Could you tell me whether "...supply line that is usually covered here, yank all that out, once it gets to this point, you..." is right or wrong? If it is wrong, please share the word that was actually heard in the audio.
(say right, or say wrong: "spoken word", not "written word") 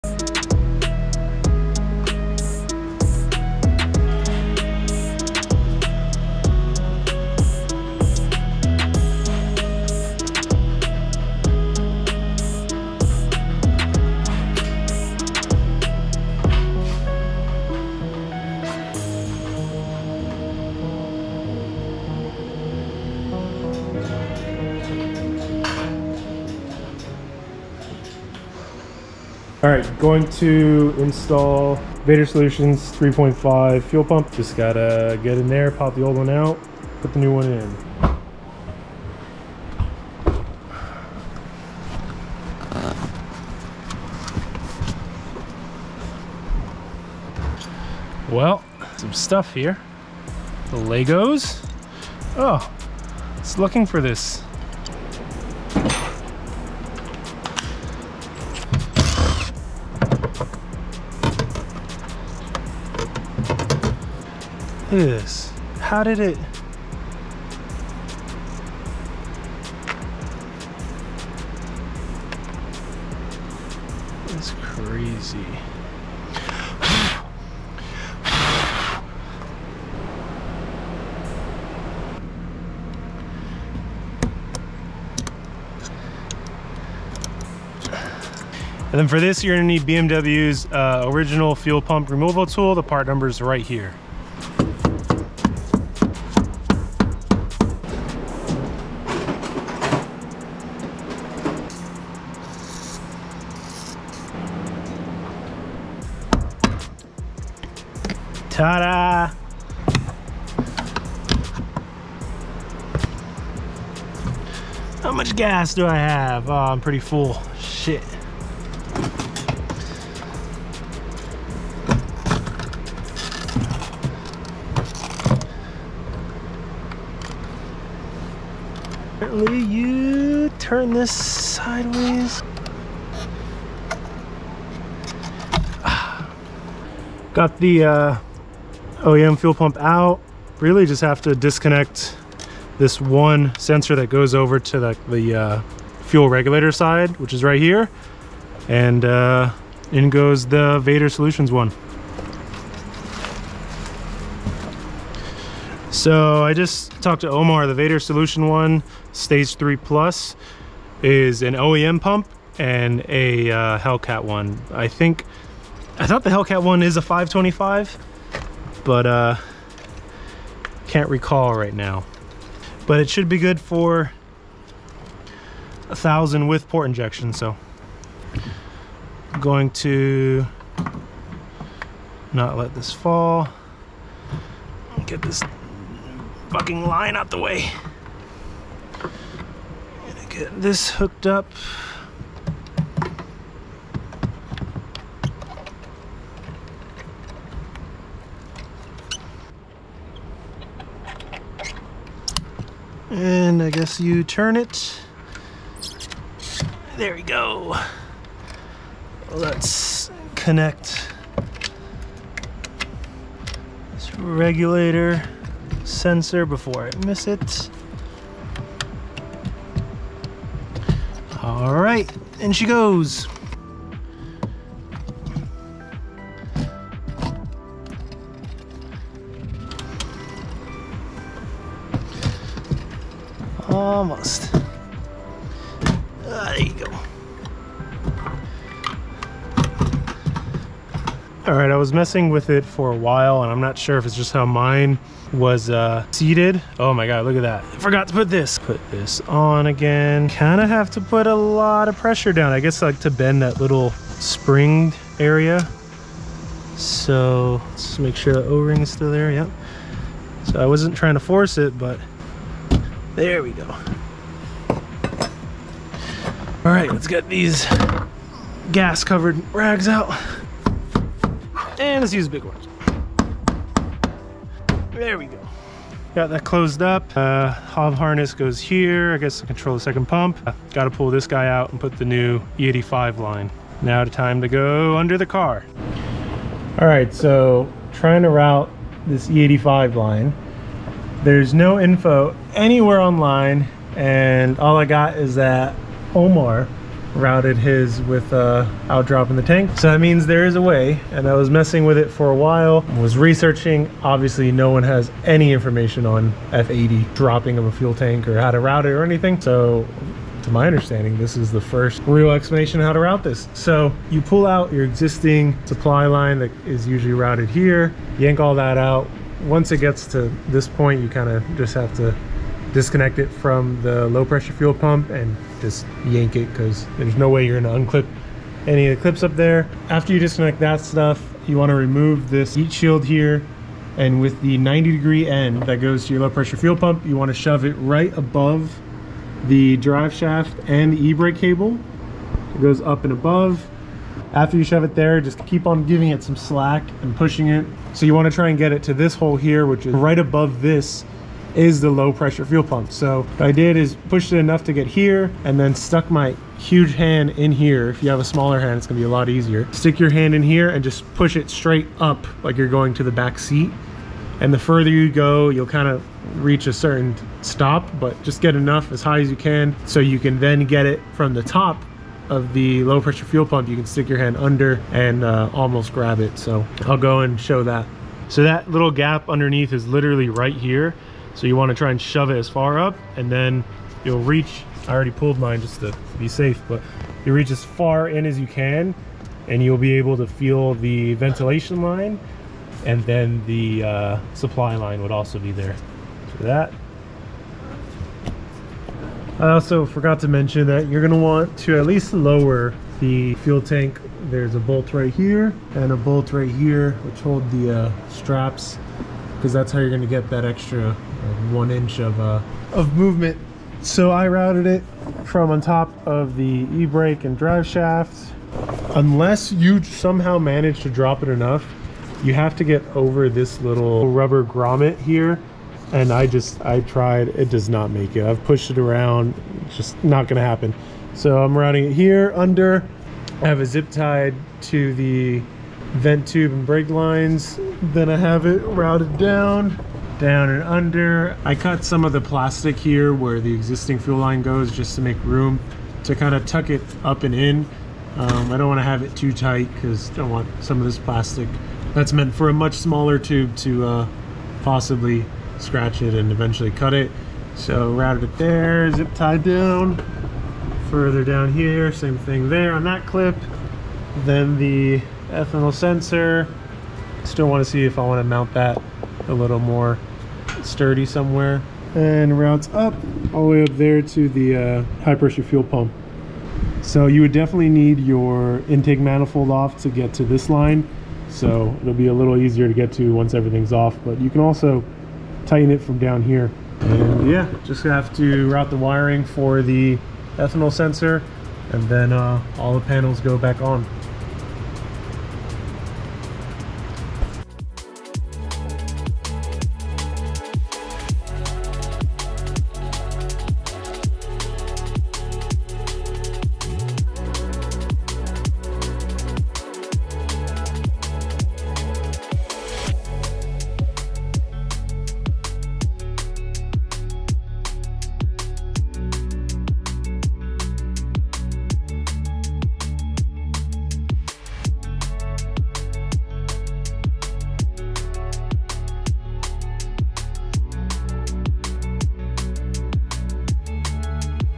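wrong: "routed", not "covered".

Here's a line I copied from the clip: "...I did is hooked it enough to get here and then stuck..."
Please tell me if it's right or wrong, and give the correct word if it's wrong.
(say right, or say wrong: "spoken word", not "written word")
wrong: "pushed", not "hooked".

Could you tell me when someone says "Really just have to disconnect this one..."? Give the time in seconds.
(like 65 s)
140 s.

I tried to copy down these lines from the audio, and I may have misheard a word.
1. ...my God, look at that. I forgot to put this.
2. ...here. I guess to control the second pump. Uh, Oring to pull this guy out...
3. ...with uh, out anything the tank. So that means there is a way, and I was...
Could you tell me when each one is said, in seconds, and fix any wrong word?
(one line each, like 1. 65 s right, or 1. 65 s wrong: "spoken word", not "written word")
1. 246 s right
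2. 278 s wrong: "Got", not "Oring"
3. 298 s wrong: "dropping", not "anything".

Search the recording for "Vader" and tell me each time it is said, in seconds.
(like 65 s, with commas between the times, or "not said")
32 s, 150 s, 157 s.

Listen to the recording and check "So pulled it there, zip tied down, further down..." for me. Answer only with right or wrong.
wrong.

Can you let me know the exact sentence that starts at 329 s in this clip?
After you disconnect that stuff, you want to remove this heat shield here.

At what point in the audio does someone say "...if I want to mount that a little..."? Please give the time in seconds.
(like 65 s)
467 s.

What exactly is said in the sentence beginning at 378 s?
So that little gap underneath is literally right here.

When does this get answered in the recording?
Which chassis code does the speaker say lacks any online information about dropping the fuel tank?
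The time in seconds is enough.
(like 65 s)
306 s.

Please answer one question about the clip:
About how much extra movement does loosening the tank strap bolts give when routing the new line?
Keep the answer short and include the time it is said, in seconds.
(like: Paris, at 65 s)
1 inch, at 411 s.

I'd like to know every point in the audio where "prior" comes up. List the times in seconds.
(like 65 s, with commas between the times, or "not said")
not said.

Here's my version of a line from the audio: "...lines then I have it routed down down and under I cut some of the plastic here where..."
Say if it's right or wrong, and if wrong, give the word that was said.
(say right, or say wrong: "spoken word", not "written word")
right.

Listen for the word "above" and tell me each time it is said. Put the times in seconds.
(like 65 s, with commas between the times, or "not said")
338 s, 343 s, 350 s.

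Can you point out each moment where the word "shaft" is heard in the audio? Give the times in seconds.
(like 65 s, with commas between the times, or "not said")
340 s, 417 s.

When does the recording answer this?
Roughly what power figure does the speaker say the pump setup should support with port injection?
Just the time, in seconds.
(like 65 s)
175 s.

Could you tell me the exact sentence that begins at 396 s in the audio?
So that I also forgot to mention that you're going to want to at least lower the fuel tank.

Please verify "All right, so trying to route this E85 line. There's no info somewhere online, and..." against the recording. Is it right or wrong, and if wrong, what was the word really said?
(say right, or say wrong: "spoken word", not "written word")
wrong: "anywhere", not "somewhere".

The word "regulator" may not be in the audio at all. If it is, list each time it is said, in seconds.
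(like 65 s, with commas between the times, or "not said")
146 s, 214 s.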